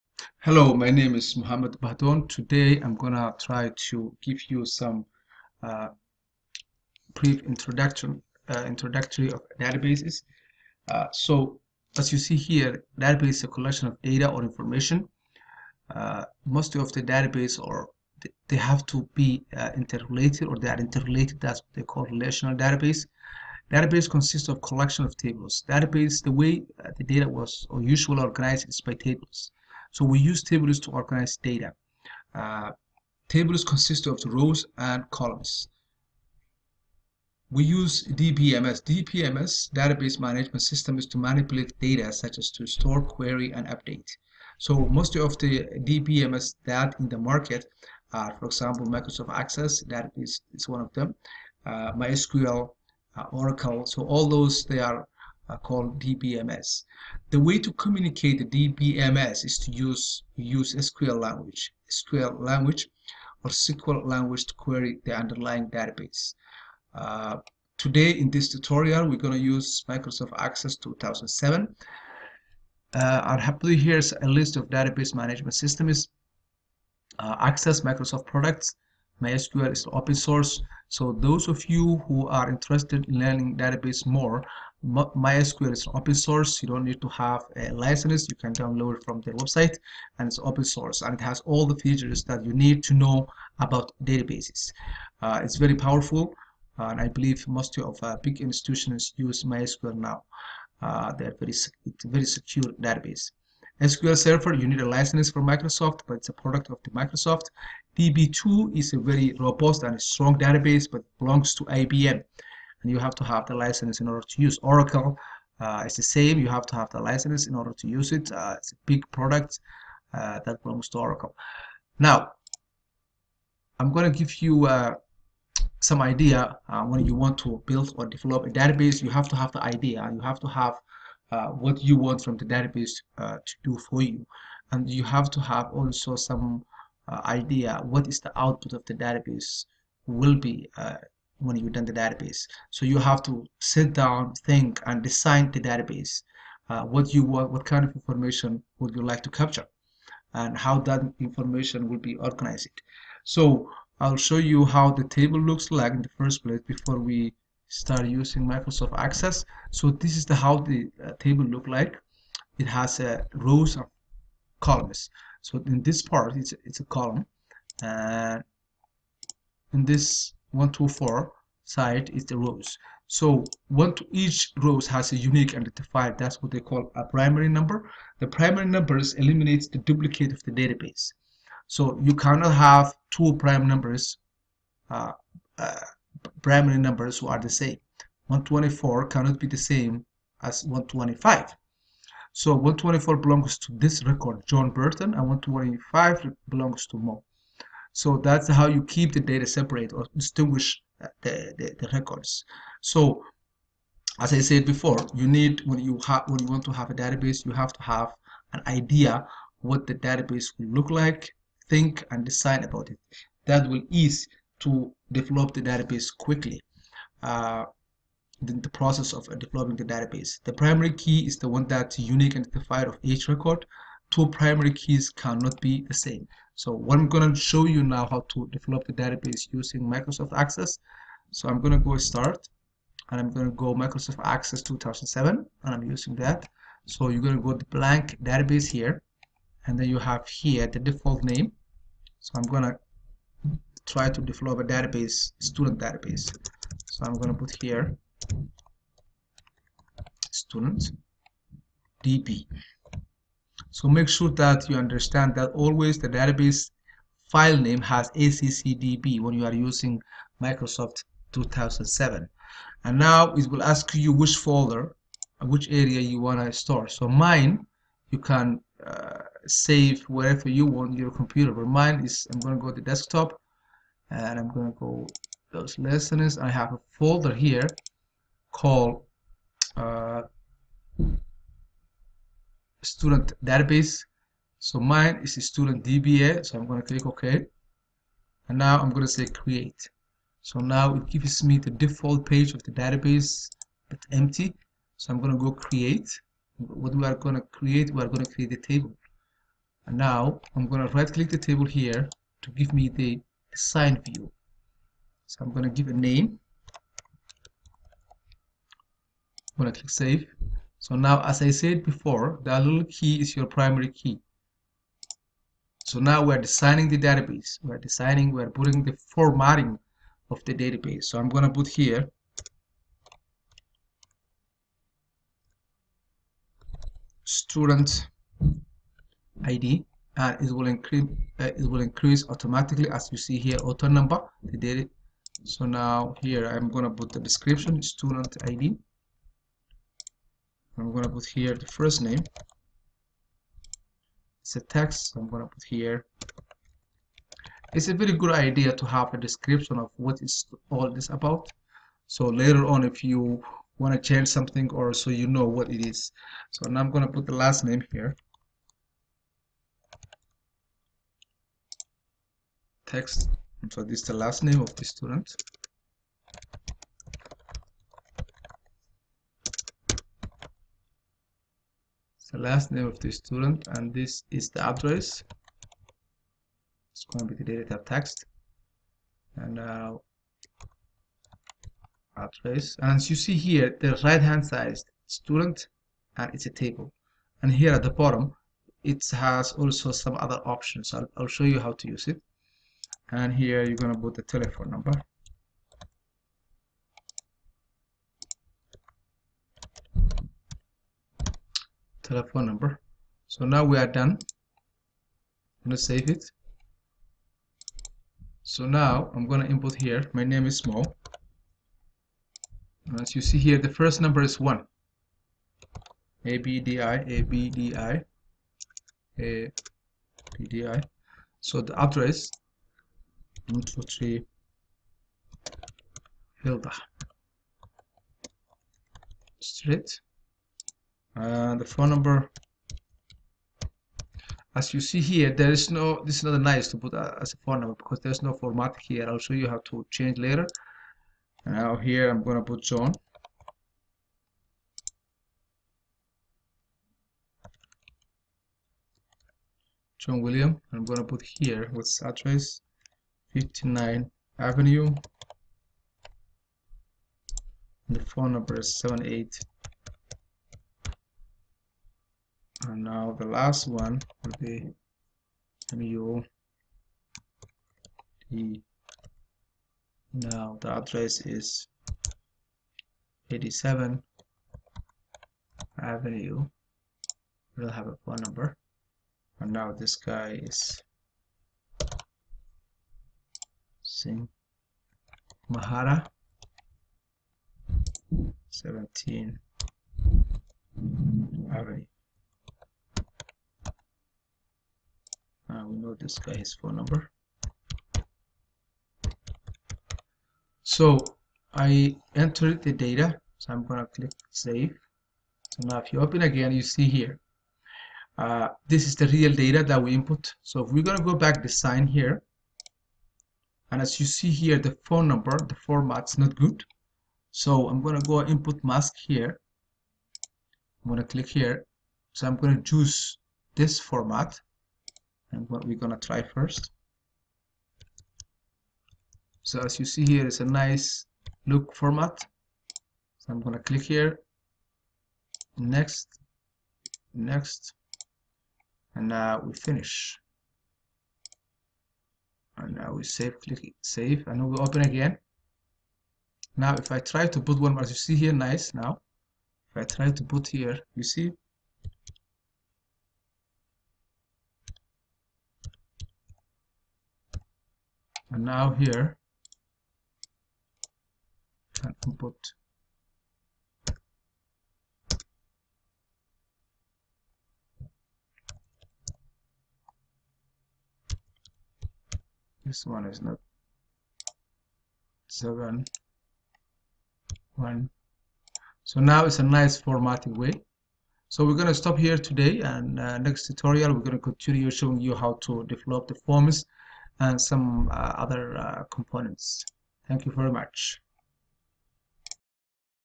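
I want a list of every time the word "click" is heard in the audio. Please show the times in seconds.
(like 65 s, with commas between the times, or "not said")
286 s, 301 s, 309 s, 503 s, 521 s, 533 s, 543 s.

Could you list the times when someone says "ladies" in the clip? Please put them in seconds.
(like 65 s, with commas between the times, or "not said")
not said.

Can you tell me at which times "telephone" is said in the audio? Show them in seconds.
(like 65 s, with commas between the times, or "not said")
394 s, 402 s.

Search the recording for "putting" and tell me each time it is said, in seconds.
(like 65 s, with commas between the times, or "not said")
318 s.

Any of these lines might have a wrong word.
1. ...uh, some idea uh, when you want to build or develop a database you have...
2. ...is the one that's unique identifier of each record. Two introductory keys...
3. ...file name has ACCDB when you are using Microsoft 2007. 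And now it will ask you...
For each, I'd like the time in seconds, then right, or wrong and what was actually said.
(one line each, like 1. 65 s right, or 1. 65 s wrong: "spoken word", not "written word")
1. 124 s right
2. 221 s wrong: "primary", not "introductory"
3. 257 s right.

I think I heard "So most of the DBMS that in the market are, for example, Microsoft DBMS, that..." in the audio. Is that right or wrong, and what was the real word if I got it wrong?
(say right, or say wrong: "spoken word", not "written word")
wrong: "Access", not "DBMS".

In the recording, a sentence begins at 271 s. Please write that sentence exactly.
But mine is, I'm going to go to desktop and I'm going to go those lessons.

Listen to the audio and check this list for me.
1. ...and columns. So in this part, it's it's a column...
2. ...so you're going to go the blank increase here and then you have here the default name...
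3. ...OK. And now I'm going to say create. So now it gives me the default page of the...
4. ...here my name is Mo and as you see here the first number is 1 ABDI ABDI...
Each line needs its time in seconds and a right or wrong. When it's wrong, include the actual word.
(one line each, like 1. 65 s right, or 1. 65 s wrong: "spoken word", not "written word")
1. 163 s right
2. 236 s wrong: "database", not "increase"
3. 287 s right
4. 409 s right.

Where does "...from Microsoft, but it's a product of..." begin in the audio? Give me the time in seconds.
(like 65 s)
105 s.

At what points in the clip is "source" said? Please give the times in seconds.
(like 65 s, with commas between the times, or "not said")
80 s, 86 s, 90 s.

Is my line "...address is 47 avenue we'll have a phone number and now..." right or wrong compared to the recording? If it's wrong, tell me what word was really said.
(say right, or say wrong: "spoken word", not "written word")
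wrong: "87", not "47".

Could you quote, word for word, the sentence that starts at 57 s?
The way to communicate the DBMS is to use use SQL language, SQL language or SQL language to query the underlying database.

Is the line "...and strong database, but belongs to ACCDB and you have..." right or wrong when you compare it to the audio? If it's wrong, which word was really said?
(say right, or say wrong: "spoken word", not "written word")
wrong: "IBM", not "ACCDB".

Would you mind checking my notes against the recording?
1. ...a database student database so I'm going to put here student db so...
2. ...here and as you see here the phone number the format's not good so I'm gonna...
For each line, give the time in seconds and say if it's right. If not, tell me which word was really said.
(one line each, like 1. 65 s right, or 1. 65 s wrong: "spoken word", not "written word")
1. 244 s right
2. 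511 s right.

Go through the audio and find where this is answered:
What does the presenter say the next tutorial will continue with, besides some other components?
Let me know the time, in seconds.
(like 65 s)
586 s.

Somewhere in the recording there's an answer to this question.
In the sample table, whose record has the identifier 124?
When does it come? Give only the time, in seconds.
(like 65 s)
194 s.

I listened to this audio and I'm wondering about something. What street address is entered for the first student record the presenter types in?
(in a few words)
123 Hilda Street.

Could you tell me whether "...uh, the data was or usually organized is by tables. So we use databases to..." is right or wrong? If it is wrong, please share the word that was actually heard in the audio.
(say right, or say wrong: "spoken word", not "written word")
wrong: "tables", not "databases".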